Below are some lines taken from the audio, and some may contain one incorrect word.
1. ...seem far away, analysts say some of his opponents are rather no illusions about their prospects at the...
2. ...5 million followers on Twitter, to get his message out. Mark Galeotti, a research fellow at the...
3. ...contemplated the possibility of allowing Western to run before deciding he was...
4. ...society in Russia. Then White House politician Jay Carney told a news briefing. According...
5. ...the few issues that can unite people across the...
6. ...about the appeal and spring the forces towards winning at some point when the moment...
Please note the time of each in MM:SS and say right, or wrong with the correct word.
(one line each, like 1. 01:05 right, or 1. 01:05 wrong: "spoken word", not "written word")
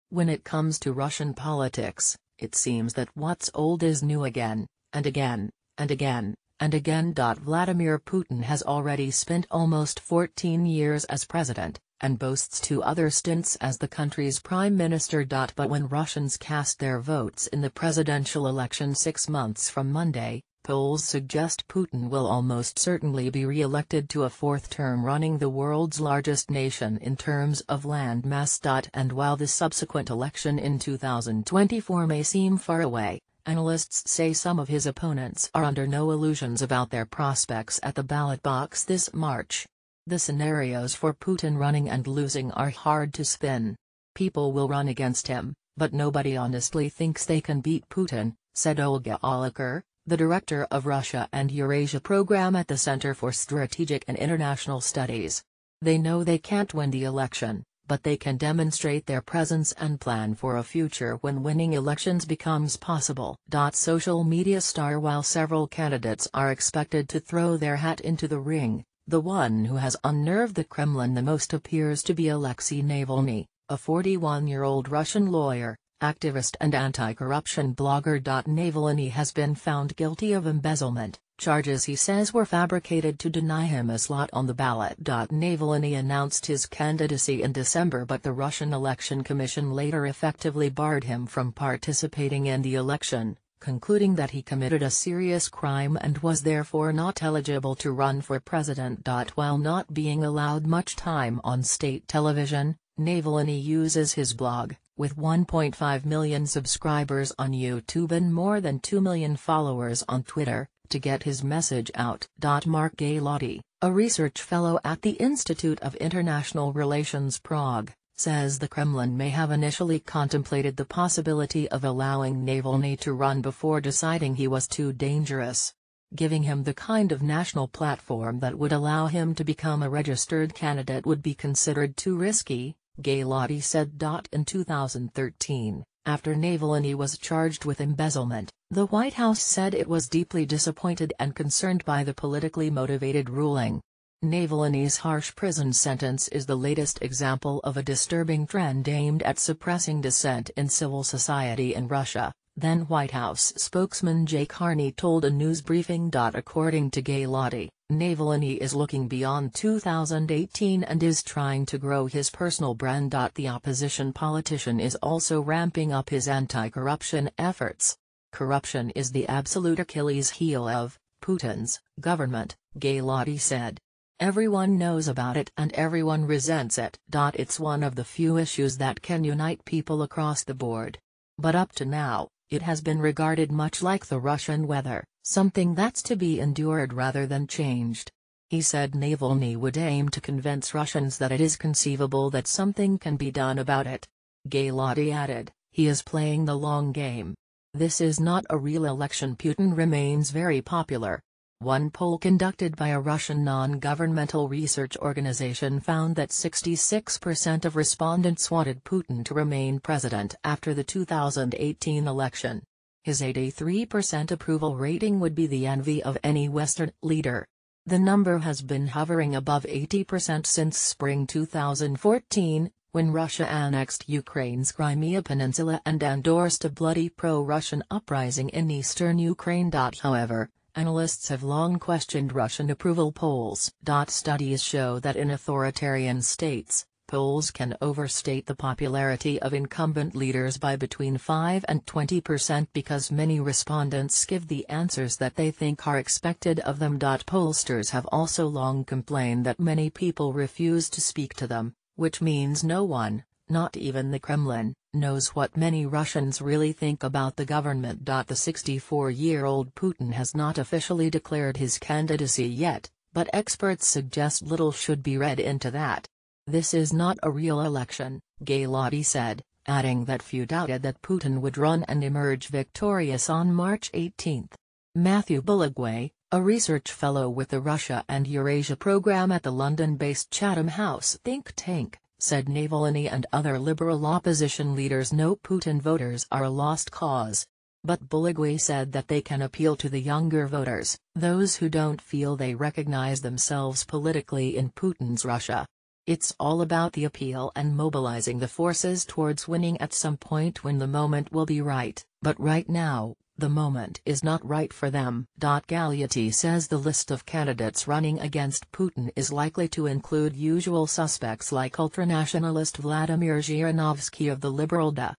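1. 00:32 wrong: "under", not "rather"
2. 01:48 wrong: "2", not "5"
3. 01:59 wrong: "Navalny", not "Western"
4. 02:31 wrong: "spokesman", not "politician"
5. 02:57 right
6. 04:56 wrong: "mobilizing", not "spring".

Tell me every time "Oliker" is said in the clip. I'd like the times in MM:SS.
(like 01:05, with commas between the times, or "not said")
00:49.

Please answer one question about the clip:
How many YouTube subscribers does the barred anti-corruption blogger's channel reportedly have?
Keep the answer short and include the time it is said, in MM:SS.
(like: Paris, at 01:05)
1.5 million, at 01:45.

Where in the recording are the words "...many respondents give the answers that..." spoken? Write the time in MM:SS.
04:03.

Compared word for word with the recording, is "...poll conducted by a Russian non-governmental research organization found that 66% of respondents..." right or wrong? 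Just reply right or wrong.
right.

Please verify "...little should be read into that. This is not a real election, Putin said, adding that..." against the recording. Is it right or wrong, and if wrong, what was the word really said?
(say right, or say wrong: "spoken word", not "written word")
wrong: "Galeotti", not "Putin".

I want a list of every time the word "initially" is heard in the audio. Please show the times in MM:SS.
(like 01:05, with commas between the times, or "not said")
01:59.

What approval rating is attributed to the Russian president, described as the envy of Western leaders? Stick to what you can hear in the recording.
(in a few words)
83%.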